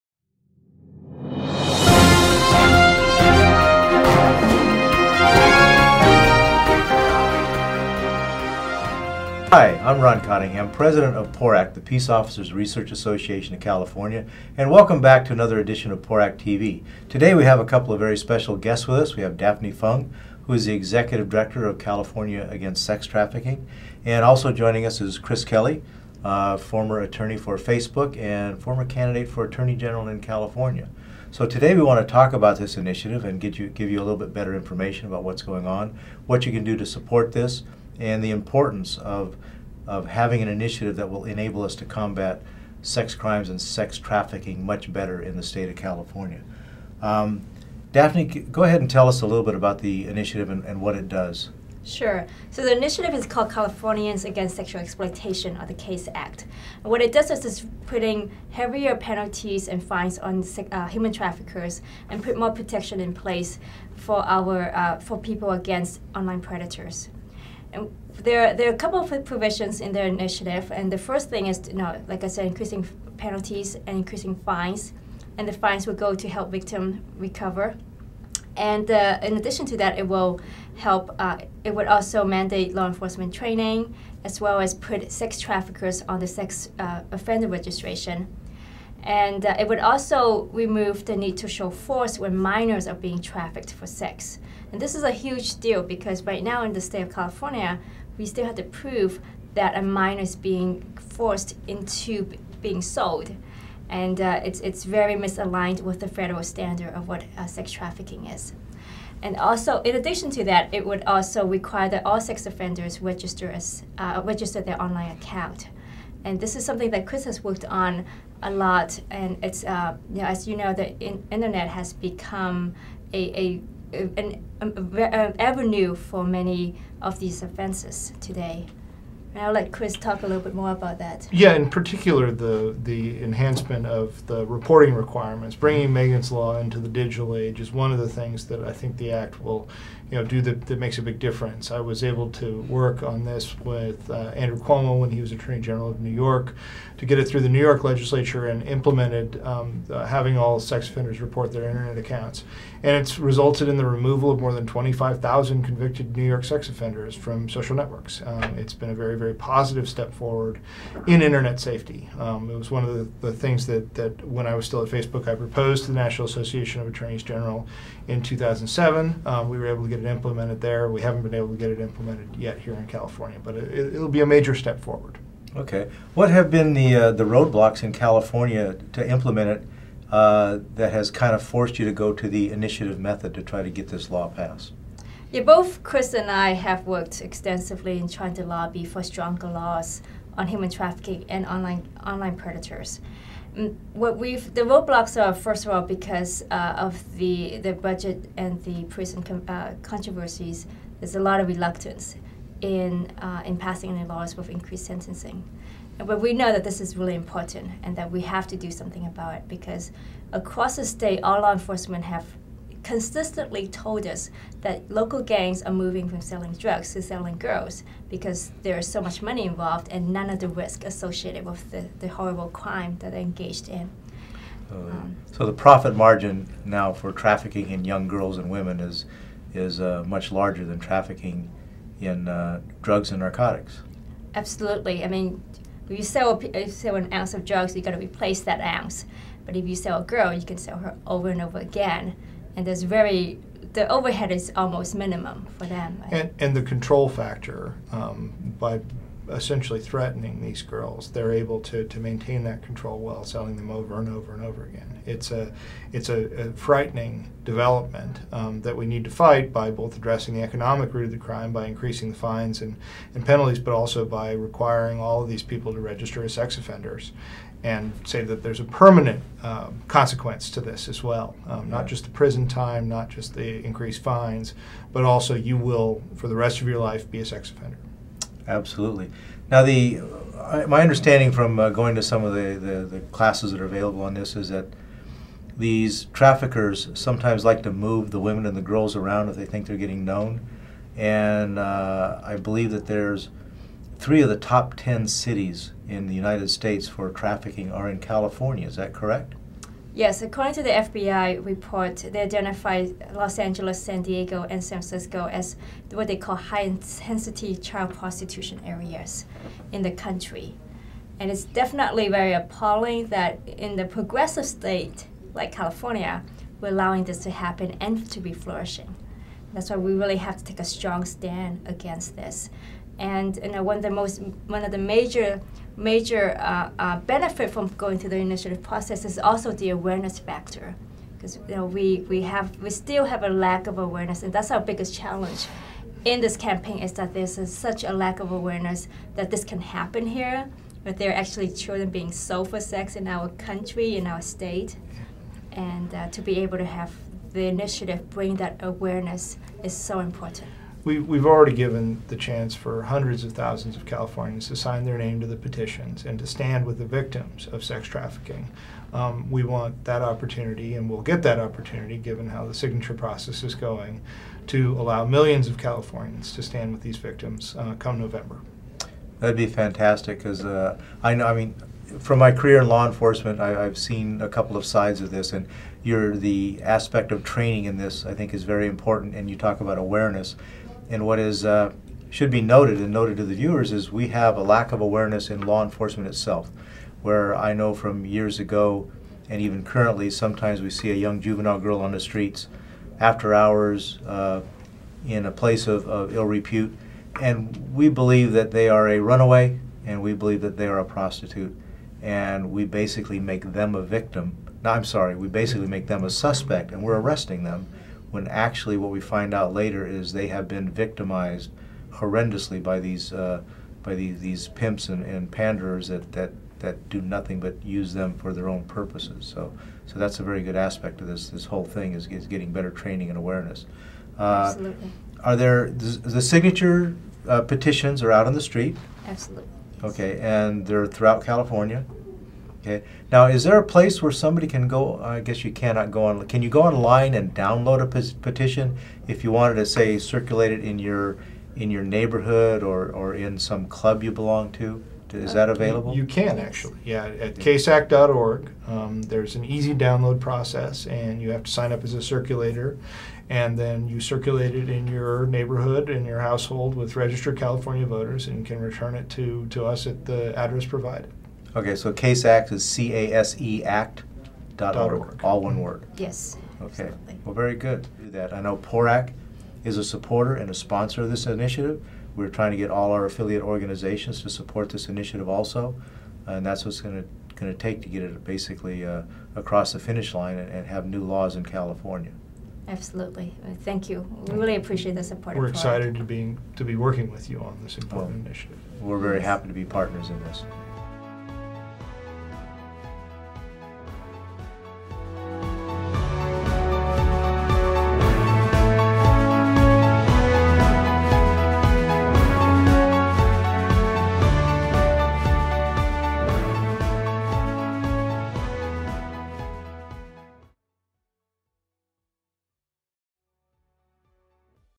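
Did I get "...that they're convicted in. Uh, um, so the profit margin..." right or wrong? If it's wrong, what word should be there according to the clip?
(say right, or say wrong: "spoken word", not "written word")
wrong: "engaged", not "convicted".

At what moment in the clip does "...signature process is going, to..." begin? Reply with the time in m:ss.
6:02.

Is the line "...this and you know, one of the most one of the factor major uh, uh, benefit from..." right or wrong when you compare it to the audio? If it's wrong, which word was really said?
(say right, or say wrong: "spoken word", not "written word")
wrong: "major", not "factor".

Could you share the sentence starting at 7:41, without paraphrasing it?
Okay, so CASE Act is C A S E Act dot org, all one word.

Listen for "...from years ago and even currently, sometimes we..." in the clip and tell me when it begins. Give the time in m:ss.
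6:27.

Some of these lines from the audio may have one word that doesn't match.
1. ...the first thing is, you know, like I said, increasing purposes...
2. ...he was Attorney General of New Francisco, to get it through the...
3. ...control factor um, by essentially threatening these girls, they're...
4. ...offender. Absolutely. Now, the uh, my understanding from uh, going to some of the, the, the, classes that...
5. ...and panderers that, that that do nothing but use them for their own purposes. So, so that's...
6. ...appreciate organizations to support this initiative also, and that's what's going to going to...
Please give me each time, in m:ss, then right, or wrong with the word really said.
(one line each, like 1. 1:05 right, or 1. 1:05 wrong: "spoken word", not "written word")
1. 1:10 wrong: "penalties", not "purposes"
2. 2:25 wrong: "York", not "Francisco"
3. 4:06 right
4. 4:37 right
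5. 6:55 right
6. 7:53 wrong: "affiliate", not "appreciate".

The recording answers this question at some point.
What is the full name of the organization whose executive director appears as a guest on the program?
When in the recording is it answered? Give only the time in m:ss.
0:21.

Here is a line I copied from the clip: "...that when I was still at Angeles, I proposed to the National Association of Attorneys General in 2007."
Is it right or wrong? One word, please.
wrong.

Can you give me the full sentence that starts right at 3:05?
Yeah, both Chris and I have worked extensively in trying to lobby for stronger laws on human trafficking and online online predators.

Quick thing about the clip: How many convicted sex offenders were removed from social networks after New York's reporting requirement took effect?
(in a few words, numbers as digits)
more than 25,000.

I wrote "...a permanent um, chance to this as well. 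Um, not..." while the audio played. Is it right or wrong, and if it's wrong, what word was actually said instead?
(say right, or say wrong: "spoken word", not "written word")
wrong: "consequence", not "chance".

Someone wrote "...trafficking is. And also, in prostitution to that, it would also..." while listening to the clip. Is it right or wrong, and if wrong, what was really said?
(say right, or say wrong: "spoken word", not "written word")
wrong: "addition", not "prostitution".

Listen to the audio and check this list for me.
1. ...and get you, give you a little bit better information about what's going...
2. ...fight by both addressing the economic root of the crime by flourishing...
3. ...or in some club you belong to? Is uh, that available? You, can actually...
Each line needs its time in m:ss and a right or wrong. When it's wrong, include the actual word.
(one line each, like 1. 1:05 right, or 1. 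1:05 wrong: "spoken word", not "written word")
1. 0:33 right
2. 4:19 wrong: "increasing", not "flourishing"
3. 7:22 right.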